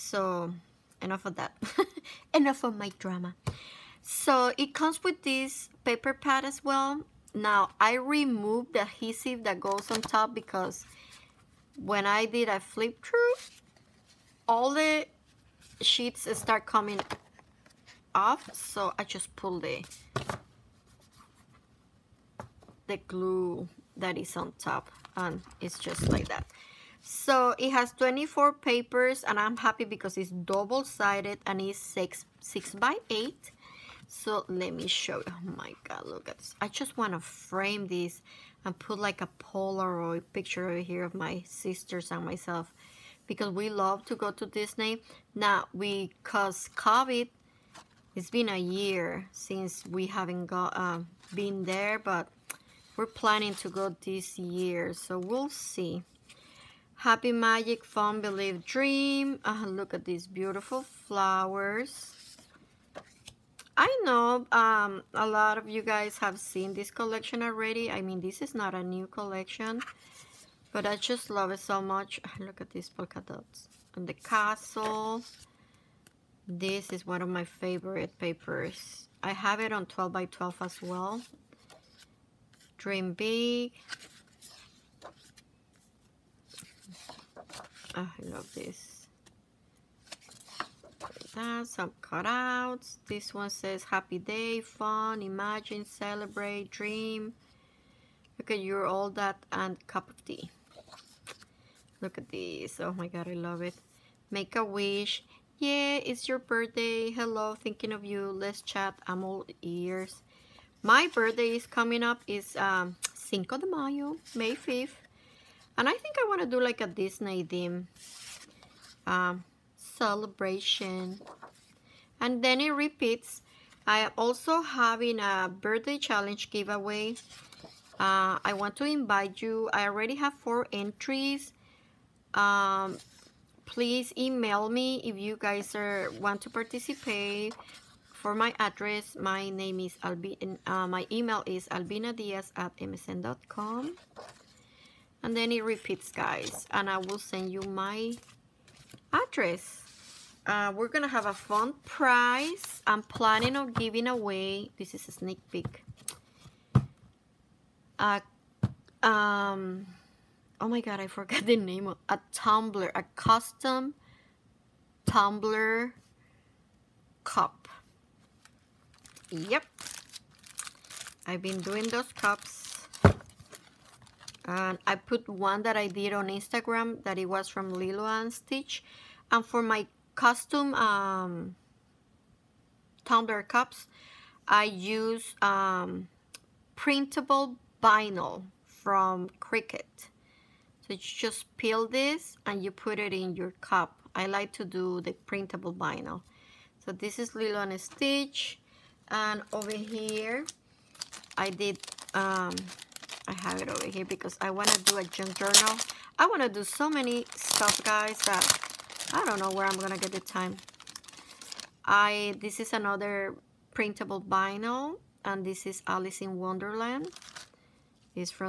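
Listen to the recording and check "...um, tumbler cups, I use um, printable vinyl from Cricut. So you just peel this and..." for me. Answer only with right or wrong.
right.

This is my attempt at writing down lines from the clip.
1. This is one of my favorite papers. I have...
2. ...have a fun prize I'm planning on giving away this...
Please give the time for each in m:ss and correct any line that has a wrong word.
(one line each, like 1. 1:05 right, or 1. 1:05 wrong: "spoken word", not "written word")
1. 1:16 right
2. 2:31 right.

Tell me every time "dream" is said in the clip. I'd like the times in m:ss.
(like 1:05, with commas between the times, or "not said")
0:58, 1:22, 1:36.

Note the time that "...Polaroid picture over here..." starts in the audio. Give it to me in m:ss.
0:39.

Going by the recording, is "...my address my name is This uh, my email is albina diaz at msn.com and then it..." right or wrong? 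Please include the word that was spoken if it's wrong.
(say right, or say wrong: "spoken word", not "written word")
wrong: "Albin", not "This".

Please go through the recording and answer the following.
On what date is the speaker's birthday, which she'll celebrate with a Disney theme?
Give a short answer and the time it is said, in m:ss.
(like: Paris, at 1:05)
May 5th, at 1:54.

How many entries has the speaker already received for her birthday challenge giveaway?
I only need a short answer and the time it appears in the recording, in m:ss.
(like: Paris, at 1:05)
4, at 2:10.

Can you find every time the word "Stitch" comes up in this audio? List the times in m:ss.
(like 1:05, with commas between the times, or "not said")
2:58, 3:17.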